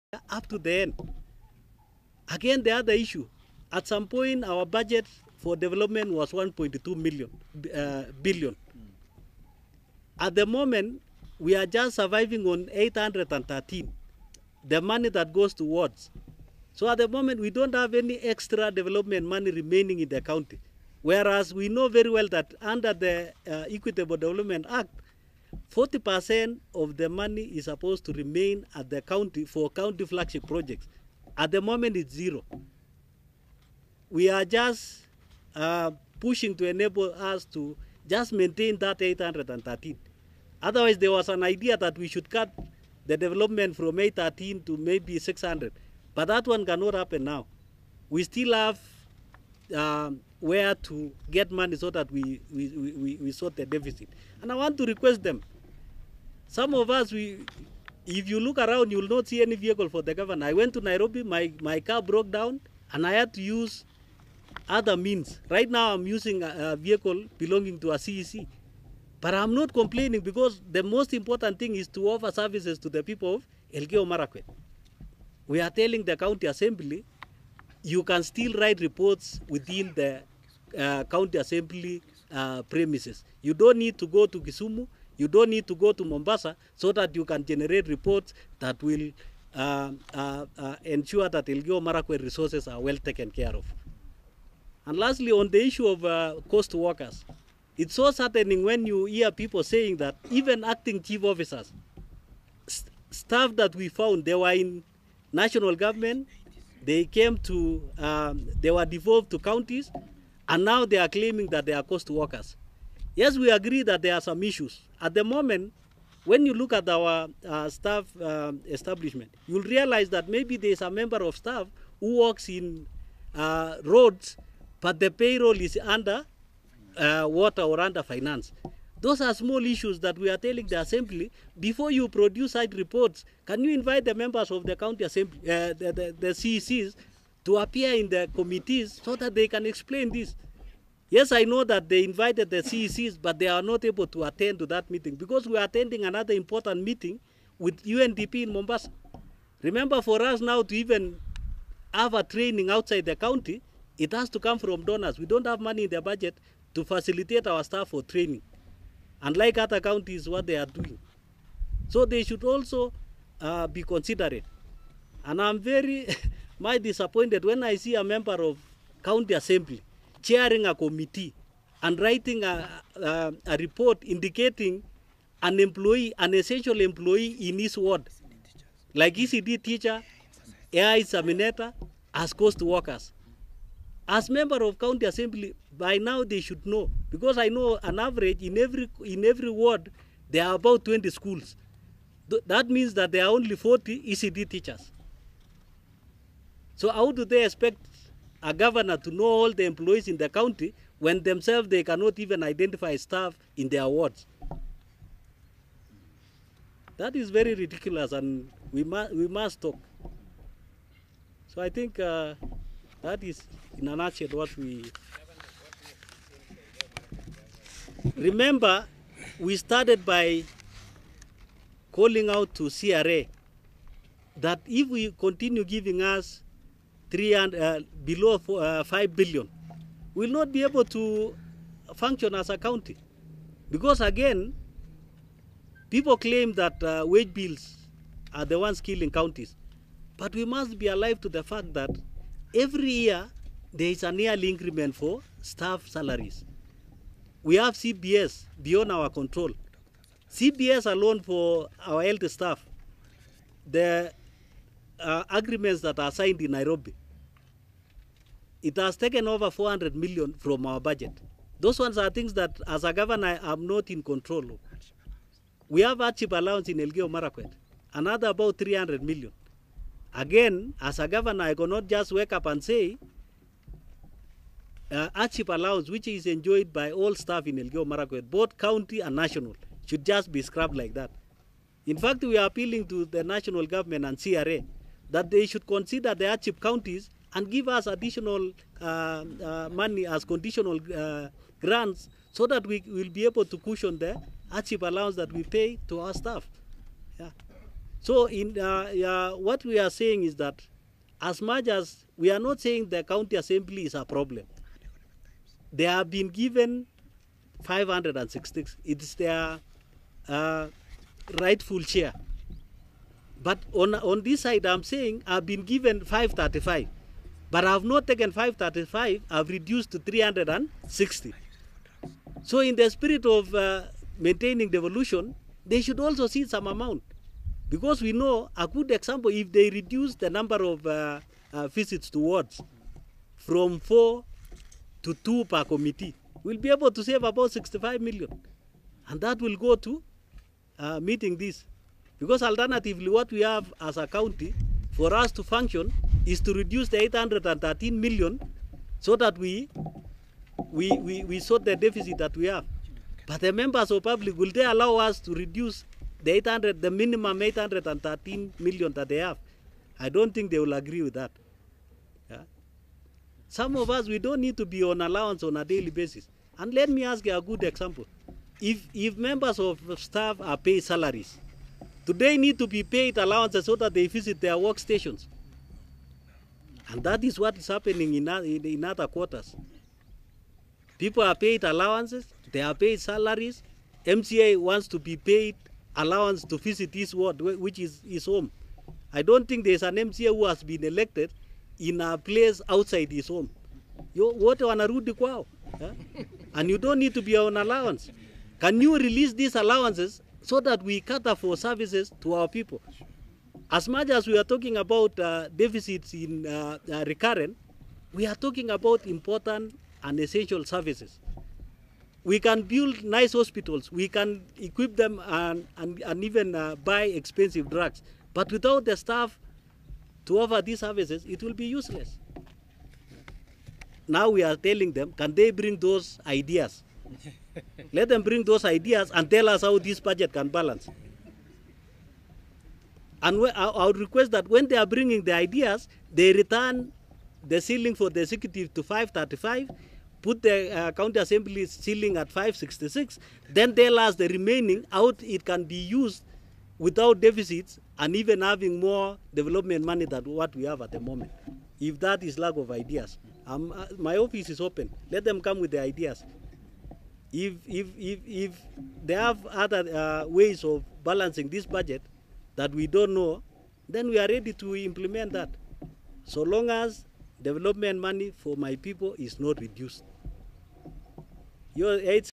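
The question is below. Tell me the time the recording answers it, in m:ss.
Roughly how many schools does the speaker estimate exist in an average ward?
3:10.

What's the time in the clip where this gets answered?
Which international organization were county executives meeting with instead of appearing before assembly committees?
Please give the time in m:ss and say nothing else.
2:27.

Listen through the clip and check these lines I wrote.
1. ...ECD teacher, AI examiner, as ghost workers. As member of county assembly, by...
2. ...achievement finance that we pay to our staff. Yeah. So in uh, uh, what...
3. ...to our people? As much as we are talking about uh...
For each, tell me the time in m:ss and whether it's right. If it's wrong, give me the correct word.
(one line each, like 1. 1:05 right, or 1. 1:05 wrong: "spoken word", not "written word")
1. 2:59 right
2. 4:54 wrong: "allowance", not "finance"
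3. 6:42 right.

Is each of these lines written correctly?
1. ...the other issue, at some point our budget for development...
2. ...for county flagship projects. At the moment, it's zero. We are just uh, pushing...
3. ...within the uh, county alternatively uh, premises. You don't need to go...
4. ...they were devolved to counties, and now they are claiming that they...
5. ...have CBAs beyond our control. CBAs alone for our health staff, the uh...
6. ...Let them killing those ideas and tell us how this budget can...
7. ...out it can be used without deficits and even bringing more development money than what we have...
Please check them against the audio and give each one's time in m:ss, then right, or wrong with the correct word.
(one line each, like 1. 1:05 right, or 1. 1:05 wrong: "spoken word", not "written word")
1. 0:02 right
2. 0:29 right
3. 1:19 wrong: "assembly", not "alternatively"
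4. 1:48 right
5. 4:07 right
6. 7:07 wrong: "bring", not "killing"
7. 7:24 wrong: "having", not "bringing".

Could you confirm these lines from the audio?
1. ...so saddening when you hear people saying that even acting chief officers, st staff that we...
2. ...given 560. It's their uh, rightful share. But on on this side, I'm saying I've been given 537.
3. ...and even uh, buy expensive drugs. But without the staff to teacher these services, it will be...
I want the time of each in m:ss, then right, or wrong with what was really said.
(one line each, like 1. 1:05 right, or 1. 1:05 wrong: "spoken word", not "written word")
1. 1:37 right
2. 5:06 wrong: "535", not "537"
3. 6:56 wrong: "offer", not "teacher".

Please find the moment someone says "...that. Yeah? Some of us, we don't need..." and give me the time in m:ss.
6:01.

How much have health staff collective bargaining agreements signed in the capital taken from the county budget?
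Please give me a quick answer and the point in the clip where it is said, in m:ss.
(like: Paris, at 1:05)
Over 400 million, at 4:19.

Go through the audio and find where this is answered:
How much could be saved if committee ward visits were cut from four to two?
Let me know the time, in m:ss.
5:37.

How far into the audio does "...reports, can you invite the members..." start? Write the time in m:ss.
2:12.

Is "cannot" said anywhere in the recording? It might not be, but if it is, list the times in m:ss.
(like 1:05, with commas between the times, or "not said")
0:46, 3:21, 4:31.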